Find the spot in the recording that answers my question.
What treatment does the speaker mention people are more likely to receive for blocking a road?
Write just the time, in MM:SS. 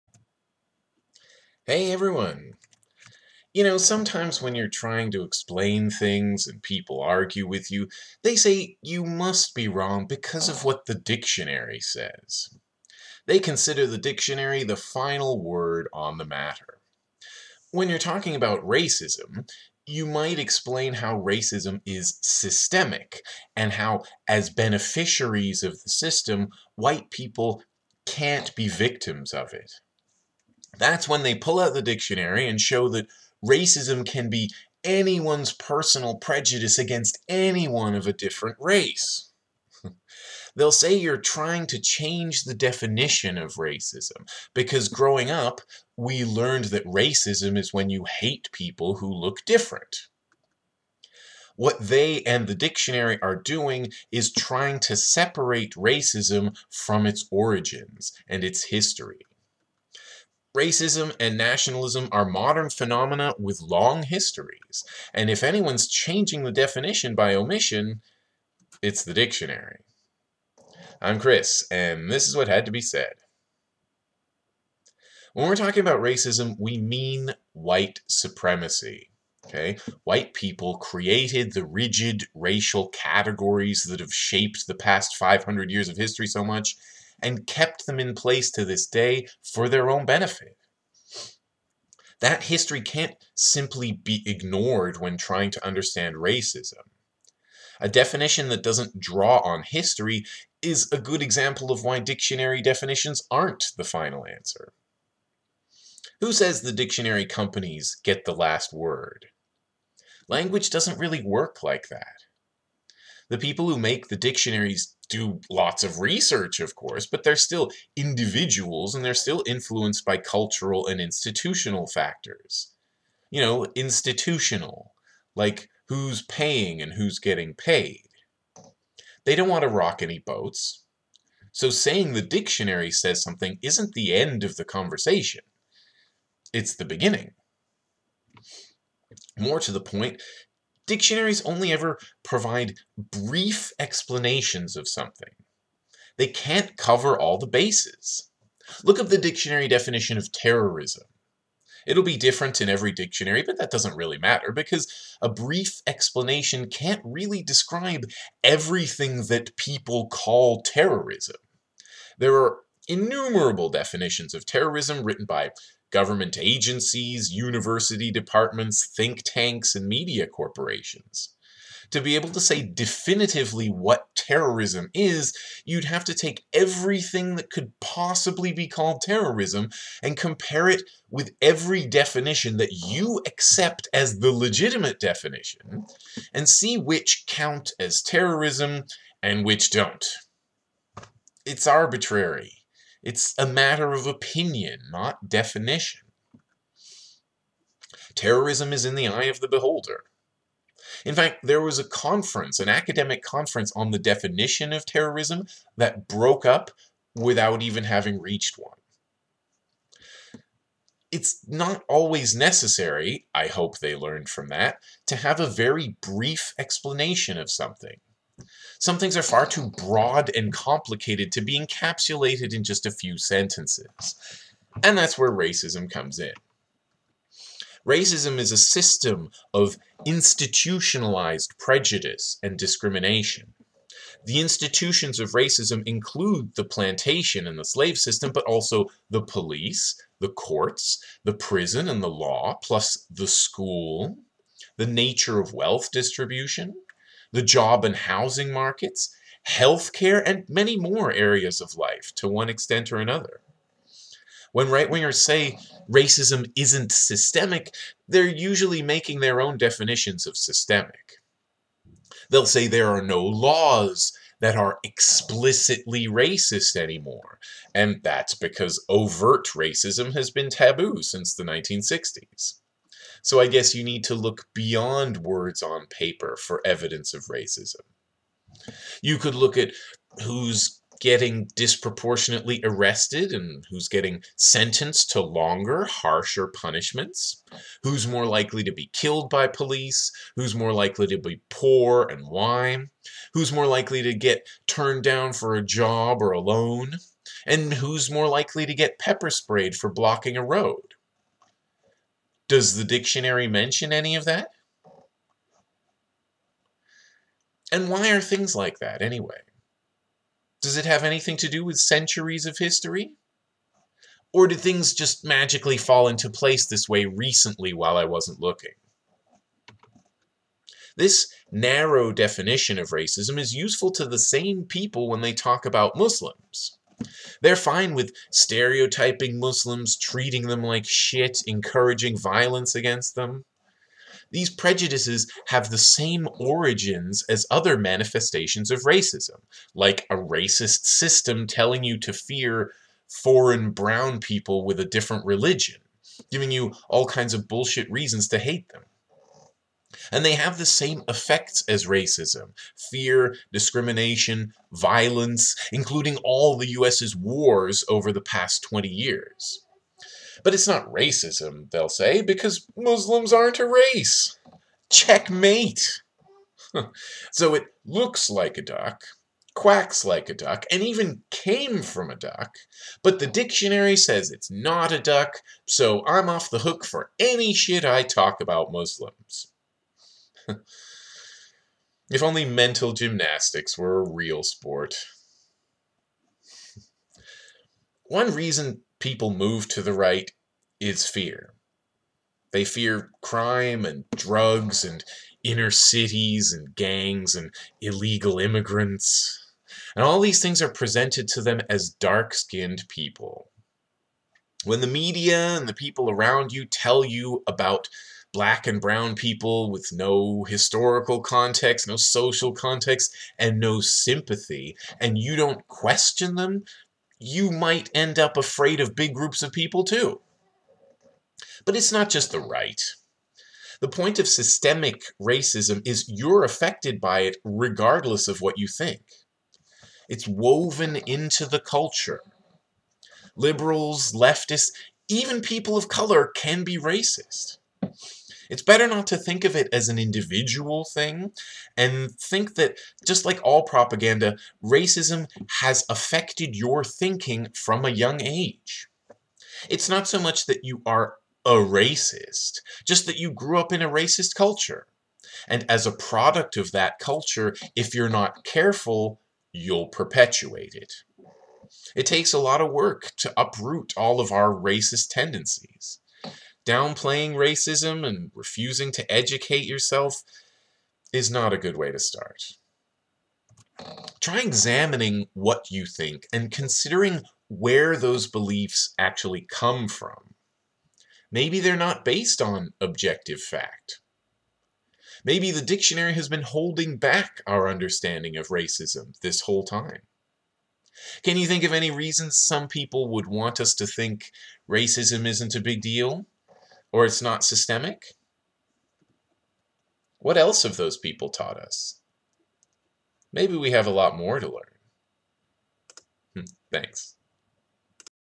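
04:58.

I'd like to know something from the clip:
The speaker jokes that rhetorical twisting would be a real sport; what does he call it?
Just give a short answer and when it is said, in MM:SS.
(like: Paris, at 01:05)
mental gymnastics, at 06:22.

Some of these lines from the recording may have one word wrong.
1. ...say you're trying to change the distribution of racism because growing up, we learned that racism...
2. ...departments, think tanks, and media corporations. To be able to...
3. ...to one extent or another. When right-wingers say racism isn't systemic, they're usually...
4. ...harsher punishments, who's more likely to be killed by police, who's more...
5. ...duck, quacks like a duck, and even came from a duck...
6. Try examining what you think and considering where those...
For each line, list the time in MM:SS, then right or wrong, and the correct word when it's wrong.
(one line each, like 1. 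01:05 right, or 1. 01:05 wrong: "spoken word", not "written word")
1. 00:40 wrong: "definition", not "distribution"
2. 02:48 right
3. 04:12 right
4. 04:45 right
5. 06:08 right
6. 07:54 right.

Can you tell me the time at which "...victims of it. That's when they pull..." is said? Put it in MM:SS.
00:28.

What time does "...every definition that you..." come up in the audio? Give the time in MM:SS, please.
03:01.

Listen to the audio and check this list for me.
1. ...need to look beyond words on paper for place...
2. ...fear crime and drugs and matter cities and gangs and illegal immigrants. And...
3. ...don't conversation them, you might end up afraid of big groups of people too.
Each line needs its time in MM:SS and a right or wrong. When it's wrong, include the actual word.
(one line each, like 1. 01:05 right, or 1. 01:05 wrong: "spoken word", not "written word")
1. 04:33 wrong: "evidence", not "place"
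2. 06:32 wrong: "inner", not "matter"
3. 06:55 wrong: "question", not "conversation".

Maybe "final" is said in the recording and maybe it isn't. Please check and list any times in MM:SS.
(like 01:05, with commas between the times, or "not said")
00:14, 01:43.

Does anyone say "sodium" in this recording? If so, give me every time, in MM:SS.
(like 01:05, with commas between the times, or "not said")
not said.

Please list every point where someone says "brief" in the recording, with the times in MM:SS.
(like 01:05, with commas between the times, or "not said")
02:22, 02:35, 03:36.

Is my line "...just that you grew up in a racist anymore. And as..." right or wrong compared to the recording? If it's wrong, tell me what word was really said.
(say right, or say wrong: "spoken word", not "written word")
wrong: "culture", not "anymore".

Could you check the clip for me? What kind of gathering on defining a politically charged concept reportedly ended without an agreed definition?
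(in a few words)
academic conference.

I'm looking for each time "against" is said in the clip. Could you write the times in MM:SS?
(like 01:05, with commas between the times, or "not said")
00:36, 05:32.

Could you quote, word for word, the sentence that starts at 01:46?
Who says the dictionary companies get the last word?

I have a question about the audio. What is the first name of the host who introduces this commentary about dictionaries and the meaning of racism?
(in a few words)
Chris.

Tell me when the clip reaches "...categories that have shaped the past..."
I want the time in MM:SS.
01:22.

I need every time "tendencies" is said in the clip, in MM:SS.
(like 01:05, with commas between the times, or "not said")
07:45.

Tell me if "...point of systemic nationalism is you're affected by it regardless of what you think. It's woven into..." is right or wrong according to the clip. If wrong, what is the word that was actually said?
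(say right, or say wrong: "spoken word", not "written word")
wrong: "racism", not "nationalism".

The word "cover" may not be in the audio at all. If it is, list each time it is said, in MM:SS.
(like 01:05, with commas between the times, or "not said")
02:26.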